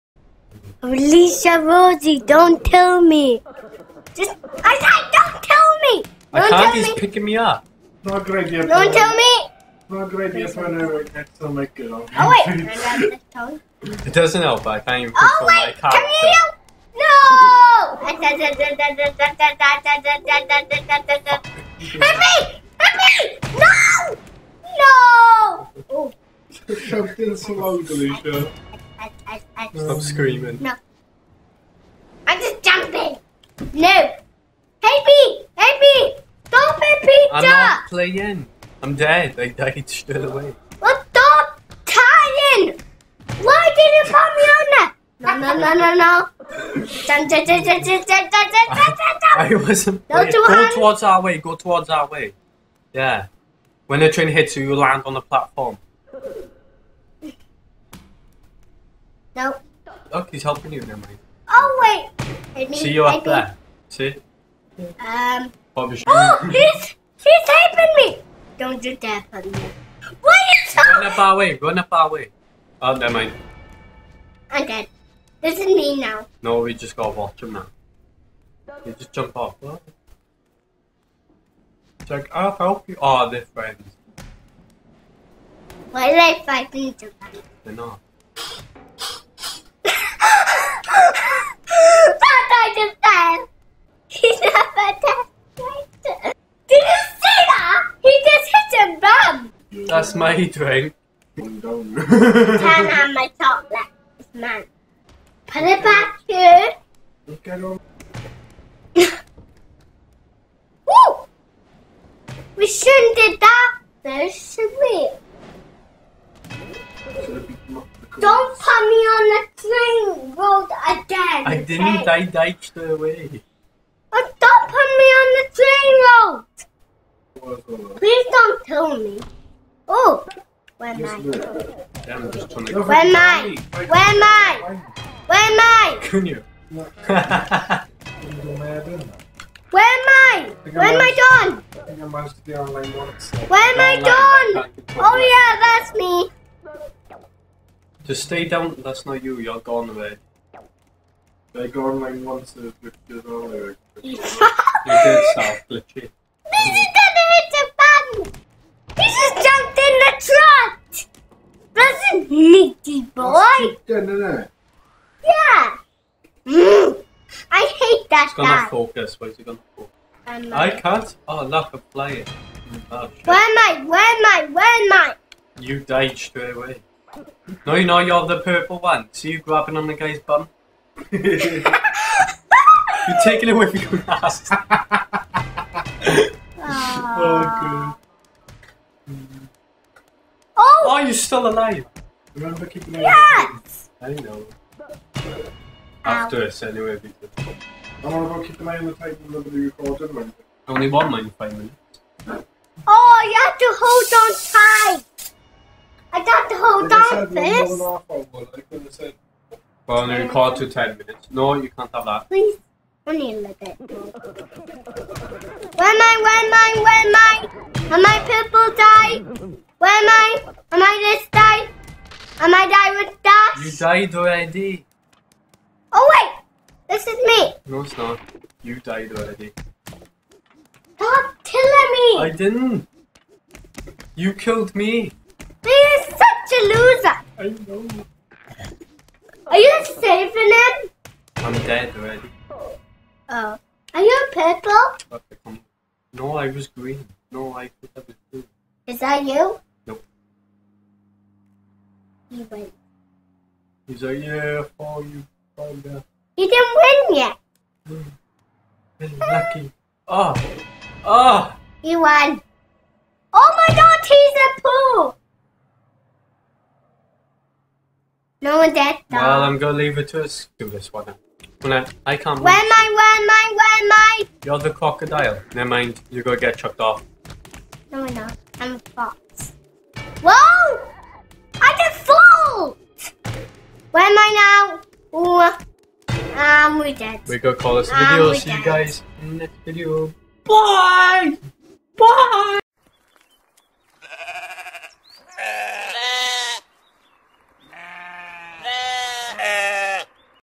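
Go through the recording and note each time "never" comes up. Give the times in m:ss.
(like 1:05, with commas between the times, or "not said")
1:12, 4:35.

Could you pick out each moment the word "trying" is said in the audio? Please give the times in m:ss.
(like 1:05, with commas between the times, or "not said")
2:12.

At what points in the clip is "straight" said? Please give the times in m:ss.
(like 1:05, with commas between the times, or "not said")
0:39, 2:56.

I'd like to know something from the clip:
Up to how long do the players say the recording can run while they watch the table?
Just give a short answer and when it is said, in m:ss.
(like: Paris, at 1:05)
10 minutes, at 3:30.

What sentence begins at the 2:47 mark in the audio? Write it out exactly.
I hate that It's gonna focus.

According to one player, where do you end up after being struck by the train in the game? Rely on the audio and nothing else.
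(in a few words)
On the platform.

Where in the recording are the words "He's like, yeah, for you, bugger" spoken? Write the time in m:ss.
4:13.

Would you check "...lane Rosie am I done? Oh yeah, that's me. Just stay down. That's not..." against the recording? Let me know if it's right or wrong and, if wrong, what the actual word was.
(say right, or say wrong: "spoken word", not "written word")
wrong: "Where", not "Rosie".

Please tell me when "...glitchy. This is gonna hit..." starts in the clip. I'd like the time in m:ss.
2:35.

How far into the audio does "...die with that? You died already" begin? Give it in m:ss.
3:42.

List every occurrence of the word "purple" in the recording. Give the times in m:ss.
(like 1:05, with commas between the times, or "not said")
2:58, 3:38, 4:04.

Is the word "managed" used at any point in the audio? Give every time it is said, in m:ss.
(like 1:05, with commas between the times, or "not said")
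2:22.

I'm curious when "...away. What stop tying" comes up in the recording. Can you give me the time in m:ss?
0:40.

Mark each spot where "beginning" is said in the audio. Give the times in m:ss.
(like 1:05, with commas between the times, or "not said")
not said.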